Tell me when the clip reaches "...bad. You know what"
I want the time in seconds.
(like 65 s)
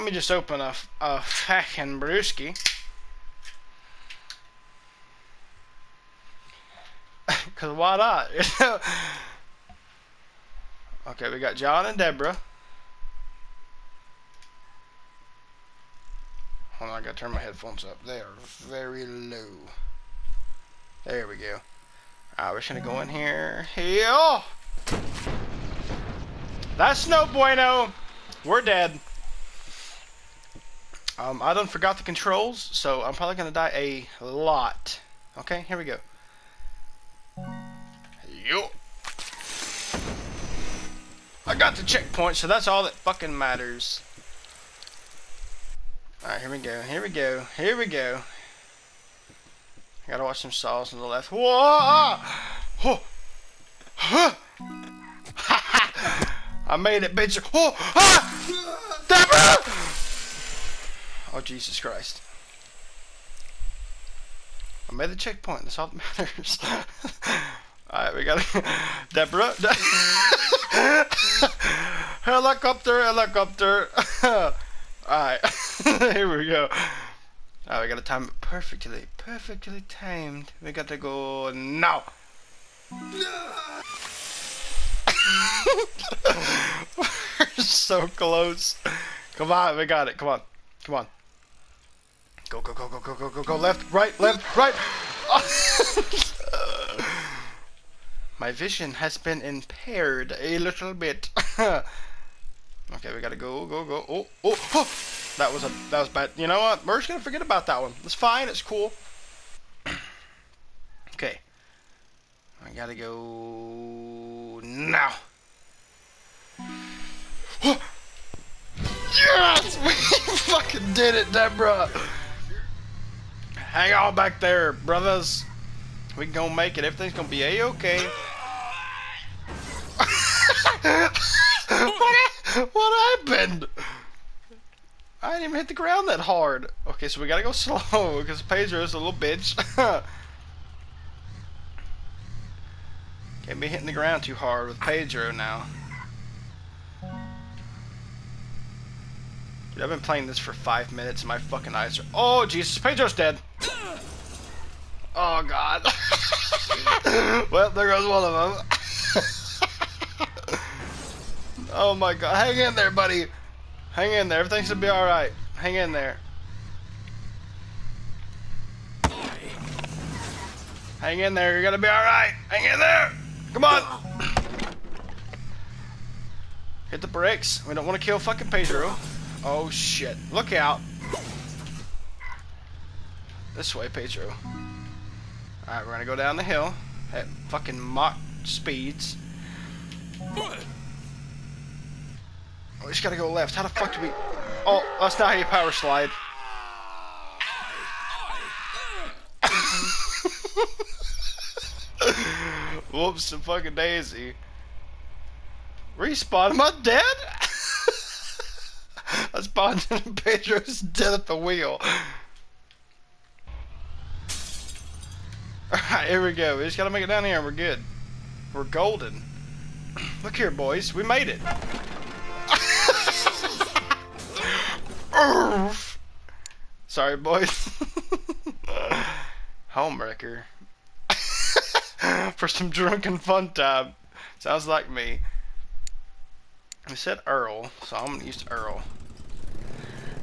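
106 s.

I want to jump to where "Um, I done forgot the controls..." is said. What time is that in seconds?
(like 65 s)
31 s.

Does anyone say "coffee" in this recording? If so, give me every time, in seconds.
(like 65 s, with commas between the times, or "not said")
not said.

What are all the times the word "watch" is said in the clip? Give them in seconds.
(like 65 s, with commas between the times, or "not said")
50 s.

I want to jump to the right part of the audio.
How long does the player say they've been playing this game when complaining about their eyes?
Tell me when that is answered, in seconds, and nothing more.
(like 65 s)
150 s.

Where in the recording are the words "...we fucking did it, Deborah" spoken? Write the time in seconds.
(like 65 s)
119 s.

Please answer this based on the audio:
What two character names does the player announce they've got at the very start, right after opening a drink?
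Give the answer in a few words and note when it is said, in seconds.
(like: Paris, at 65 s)
John and Deborah, at 11 s.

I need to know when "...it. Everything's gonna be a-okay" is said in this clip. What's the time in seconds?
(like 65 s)
126 s.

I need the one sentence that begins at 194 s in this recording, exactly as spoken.
Oh, that's not how you power slide.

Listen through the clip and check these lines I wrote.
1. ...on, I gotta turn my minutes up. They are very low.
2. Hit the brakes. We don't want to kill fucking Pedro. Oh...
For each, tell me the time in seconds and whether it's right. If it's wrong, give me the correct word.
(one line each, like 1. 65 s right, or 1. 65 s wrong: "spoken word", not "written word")
1. 16 s wrong: "headphones", not "minutes"
2. 176 s right.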